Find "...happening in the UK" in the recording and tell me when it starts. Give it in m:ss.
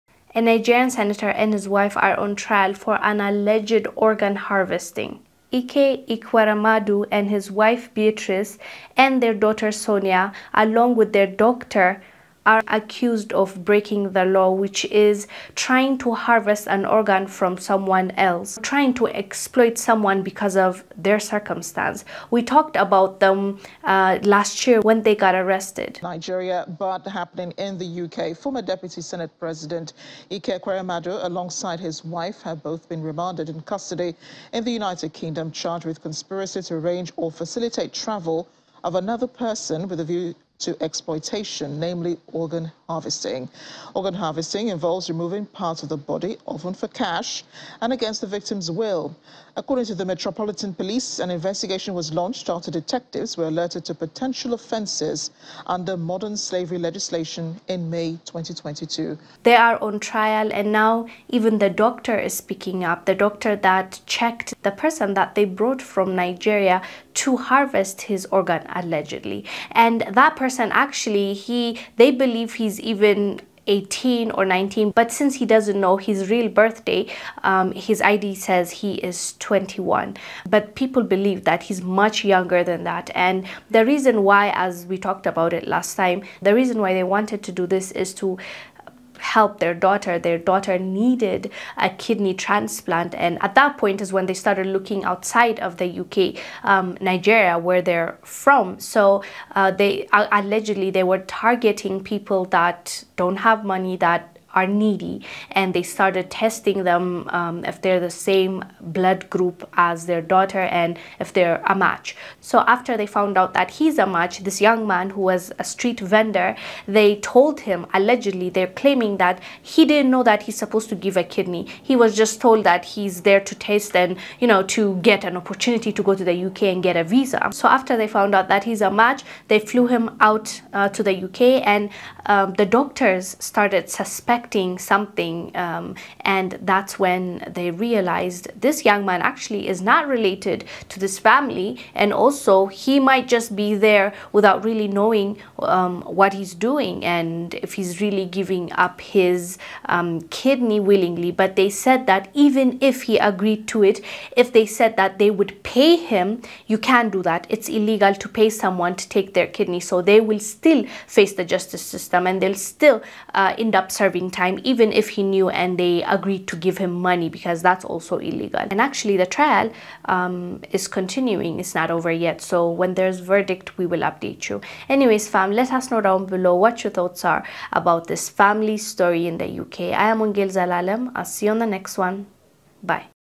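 0:27.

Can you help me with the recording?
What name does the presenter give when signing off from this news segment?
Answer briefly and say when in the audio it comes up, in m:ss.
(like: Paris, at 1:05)
Wongel Zelalem, at 3:00.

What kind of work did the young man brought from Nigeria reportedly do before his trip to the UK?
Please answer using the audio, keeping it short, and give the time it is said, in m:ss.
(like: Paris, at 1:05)
Street vendor, at 1:55.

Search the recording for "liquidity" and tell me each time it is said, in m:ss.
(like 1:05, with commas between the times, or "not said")
not said.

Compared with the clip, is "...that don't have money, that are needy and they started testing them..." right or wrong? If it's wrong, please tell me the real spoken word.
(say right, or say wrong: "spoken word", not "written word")
right.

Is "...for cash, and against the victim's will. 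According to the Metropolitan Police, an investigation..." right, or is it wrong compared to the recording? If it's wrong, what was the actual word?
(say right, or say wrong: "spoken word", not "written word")
right.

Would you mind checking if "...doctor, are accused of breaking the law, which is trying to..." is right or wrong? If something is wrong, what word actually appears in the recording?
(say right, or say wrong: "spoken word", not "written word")
right.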